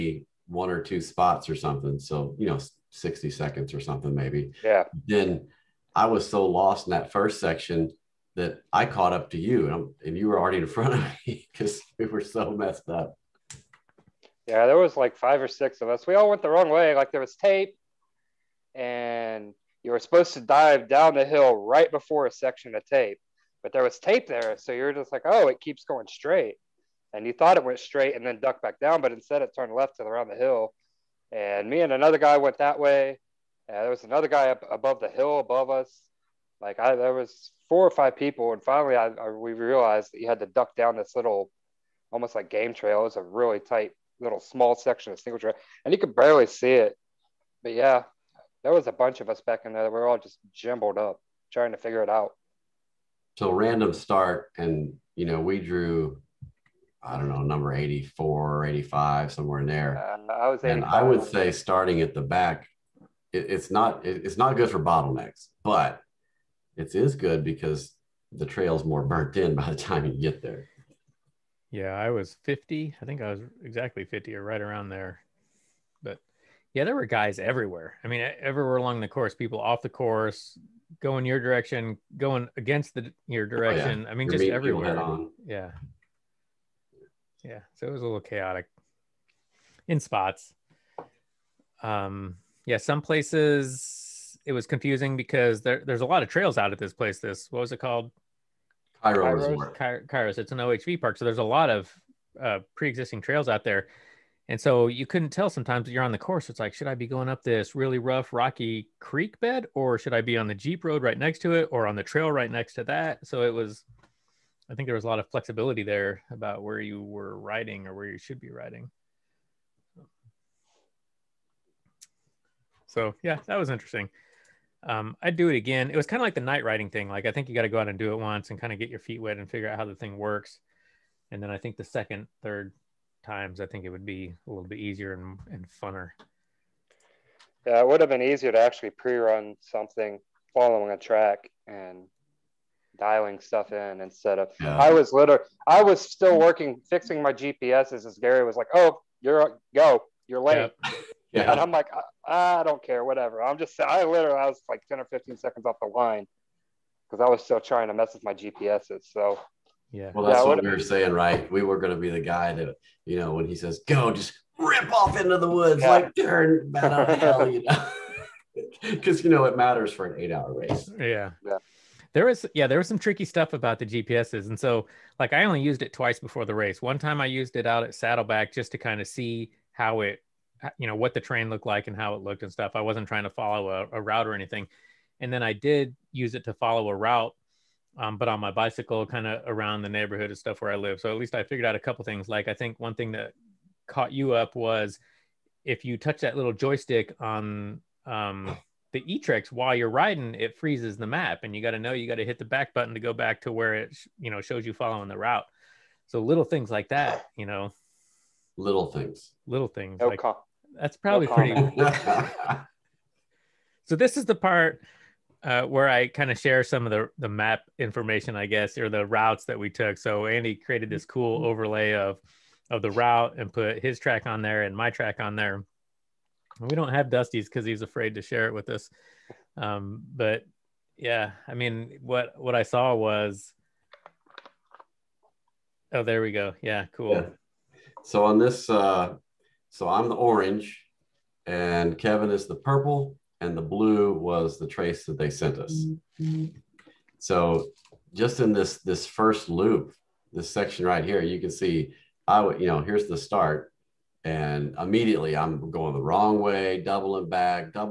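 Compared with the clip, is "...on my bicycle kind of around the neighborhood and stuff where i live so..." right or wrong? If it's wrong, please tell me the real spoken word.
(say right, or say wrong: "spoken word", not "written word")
right.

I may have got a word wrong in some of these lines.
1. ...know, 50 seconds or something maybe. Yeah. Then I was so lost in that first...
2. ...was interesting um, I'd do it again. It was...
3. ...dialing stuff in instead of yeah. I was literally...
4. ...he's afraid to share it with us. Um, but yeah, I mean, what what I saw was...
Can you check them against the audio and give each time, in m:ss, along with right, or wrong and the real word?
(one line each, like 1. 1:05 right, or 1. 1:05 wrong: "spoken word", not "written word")
1. 0:02 wrong: "60", not "50"
2. 2:03 right
3. 2:22 right
4. 3:47 right.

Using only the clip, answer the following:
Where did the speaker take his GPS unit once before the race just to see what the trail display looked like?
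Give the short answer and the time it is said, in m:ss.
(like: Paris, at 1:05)
Saddleback, at 2:57.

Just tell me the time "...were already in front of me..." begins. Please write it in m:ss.
0:10.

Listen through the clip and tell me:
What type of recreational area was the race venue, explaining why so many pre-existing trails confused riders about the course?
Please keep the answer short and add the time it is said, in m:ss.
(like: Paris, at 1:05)
OHV park, at 1:40.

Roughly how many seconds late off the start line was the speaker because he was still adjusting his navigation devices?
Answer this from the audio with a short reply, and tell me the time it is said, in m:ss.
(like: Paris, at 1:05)
10 or 15 seconds, at 2:34.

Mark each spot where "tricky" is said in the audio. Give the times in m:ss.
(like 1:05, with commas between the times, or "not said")
2:52.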